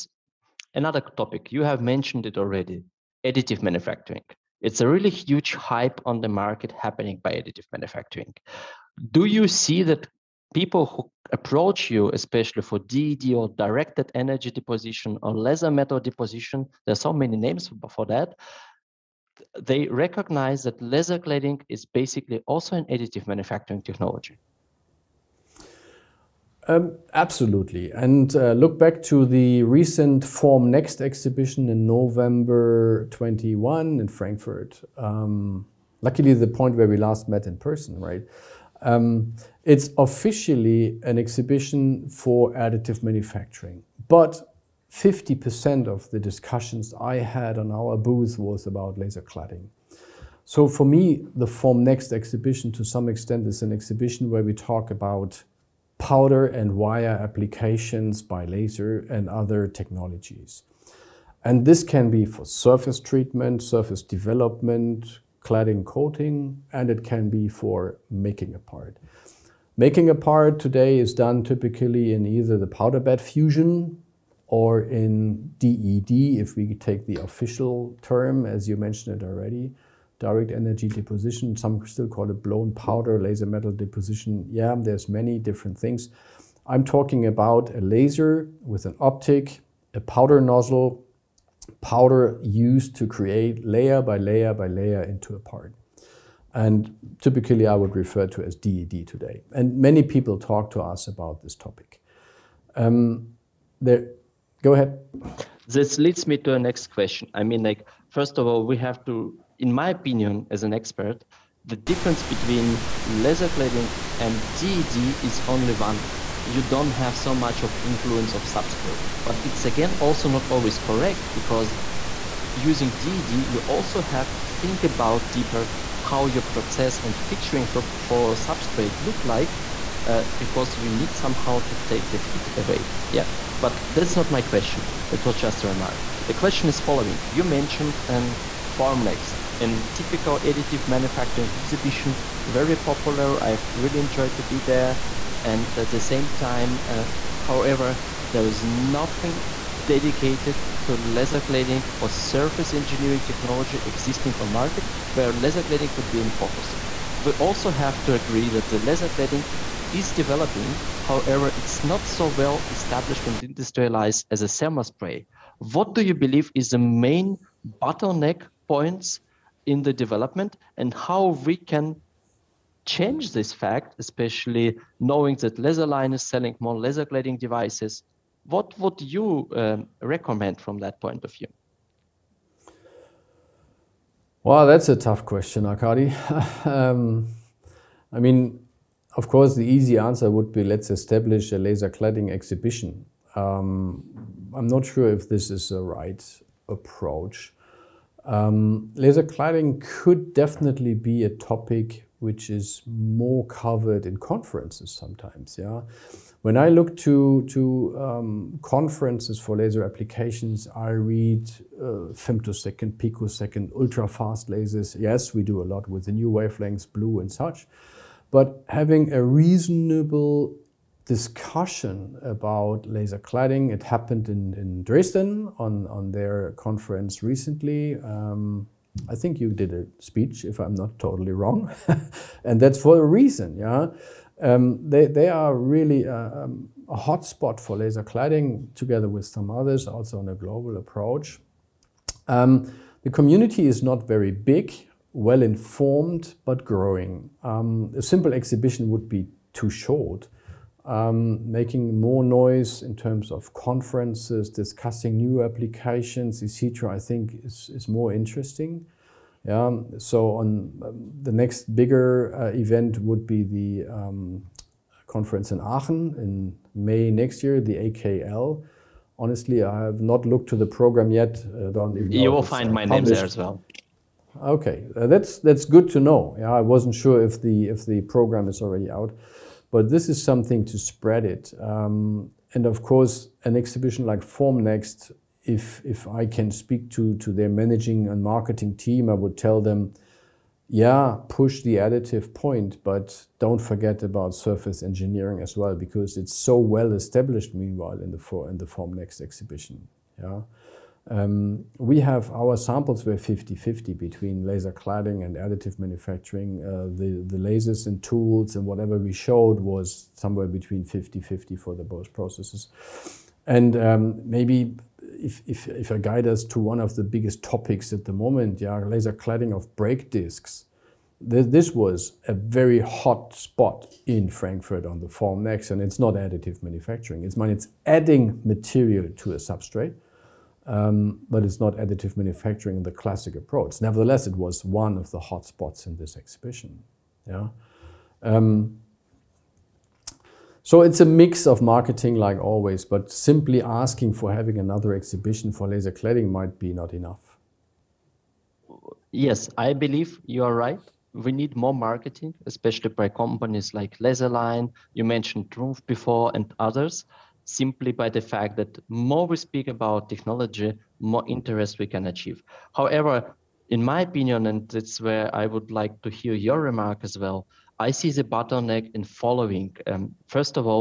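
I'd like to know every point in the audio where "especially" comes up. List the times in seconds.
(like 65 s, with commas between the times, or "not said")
12 s, 173 s, 352 s.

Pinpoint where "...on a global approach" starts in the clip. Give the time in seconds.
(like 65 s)
240 s.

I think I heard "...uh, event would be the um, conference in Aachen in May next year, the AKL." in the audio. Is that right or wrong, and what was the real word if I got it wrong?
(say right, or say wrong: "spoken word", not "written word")
right.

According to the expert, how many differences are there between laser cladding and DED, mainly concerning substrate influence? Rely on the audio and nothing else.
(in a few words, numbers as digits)
1.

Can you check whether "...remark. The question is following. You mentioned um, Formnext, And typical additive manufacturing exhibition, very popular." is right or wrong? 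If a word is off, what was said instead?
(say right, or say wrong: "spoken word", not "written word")
right.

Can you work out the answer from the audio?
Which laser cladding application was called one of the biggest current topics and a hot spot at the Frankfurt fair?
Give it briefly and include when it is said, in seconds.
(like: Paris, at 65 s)
brake discs, at 319 s.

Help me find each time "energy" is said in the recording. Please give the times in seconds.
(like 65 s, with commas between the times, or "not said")
14 s, 80 s.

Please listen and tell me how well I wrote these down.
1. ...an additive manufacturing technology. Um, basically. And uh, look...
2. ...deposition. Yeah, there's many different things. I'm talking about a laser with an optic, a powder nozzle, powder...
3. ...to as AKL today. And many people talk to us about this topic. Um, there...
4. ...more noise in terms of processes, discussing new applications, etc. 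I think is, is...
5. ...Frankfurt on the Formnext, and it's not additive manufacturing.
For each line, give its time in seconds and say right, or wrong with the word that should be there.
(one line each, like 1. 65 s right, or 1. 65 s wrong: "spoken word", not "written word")
1. 22 s wrong: "absolutely", not "basically"
2. 83 s right
3. 98 s wrong: "DED", not "AKL"
4. 251 s wrong: "conferences", not "processes"
5. 324 s right.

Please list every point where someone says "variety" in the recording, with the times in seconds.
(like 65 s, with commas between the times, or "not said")
not said.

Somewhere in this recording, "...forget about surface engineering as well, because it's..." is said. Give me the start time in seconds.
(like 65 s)
293 s.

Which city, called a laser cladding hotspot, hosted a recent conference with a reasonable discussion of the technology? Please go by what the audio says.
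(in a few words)
Dresden.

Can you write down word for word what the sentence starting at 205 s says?
Yeah, when I look to to um, conferences for laser applications, I read uh, femtosecond, picosecond, ultra fast lasers.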